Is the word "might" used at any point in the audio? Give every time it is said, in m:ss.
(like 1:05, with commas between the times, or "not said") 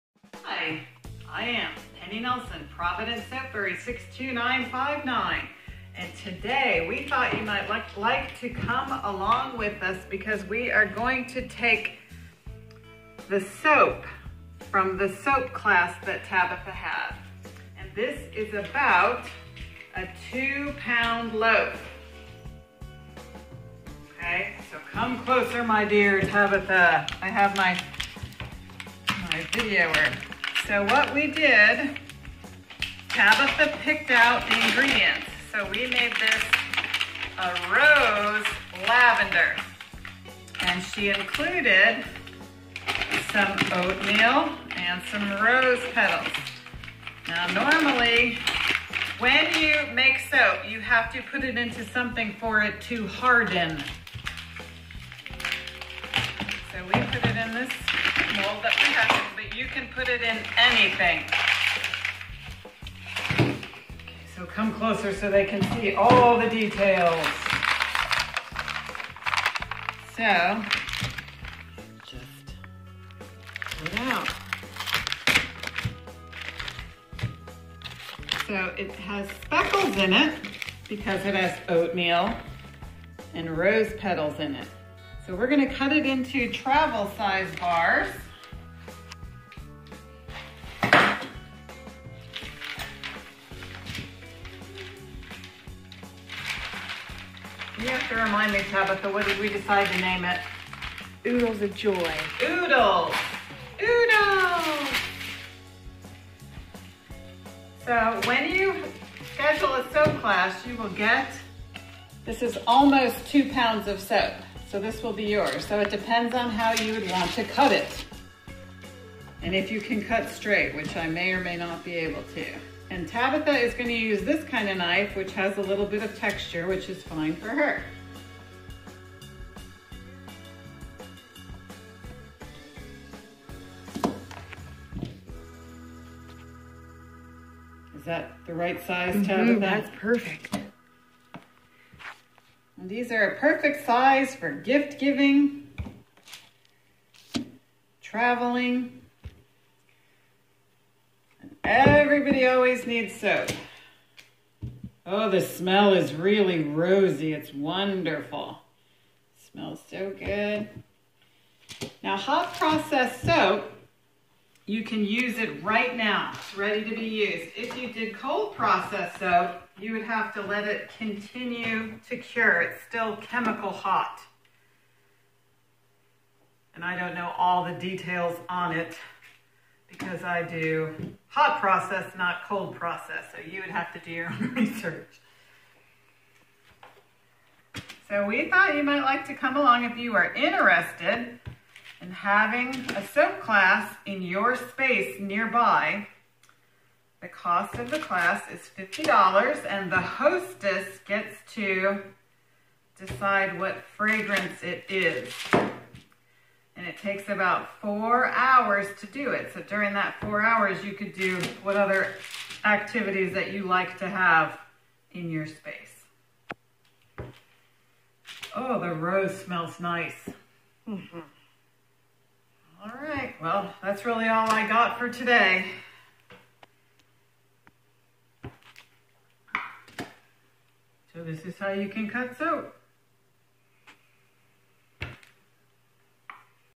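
0:07, 3:08.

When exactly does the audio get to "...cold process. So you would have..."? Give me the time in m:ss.
3:02.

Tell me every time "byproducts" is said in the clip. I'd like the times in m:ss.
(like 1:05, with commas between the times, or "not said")
not said.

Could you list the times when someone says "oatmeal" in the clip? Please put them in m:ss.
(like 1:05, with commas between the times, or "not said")
0:43, 1:21.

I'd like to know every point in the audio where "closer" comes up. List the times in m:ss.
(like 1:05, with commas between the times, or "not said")
0:25, 1:04.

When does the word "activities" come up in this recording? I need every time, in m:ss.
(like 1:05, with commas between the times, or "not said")
3:32.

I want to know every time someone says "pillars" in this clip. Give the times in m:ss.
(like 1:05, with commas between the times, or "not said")
not said.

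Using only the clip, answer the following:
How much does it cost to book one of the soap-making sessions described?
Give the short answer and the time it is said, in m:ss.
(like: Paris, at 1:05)
$50, at 3:18.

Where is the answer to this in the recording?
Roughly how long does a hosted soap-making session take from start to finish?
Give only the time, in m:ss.
3:27.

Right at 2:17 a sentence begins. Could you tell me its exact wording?
Is that the right size, mm -hmm, Tabitha?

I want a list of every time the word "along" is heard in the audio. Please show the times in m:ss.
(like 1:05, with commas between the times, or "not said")
0:09, 3:09.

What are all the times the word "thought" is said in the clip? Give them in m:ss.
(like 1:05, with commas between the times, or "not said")
0:07, 3:08.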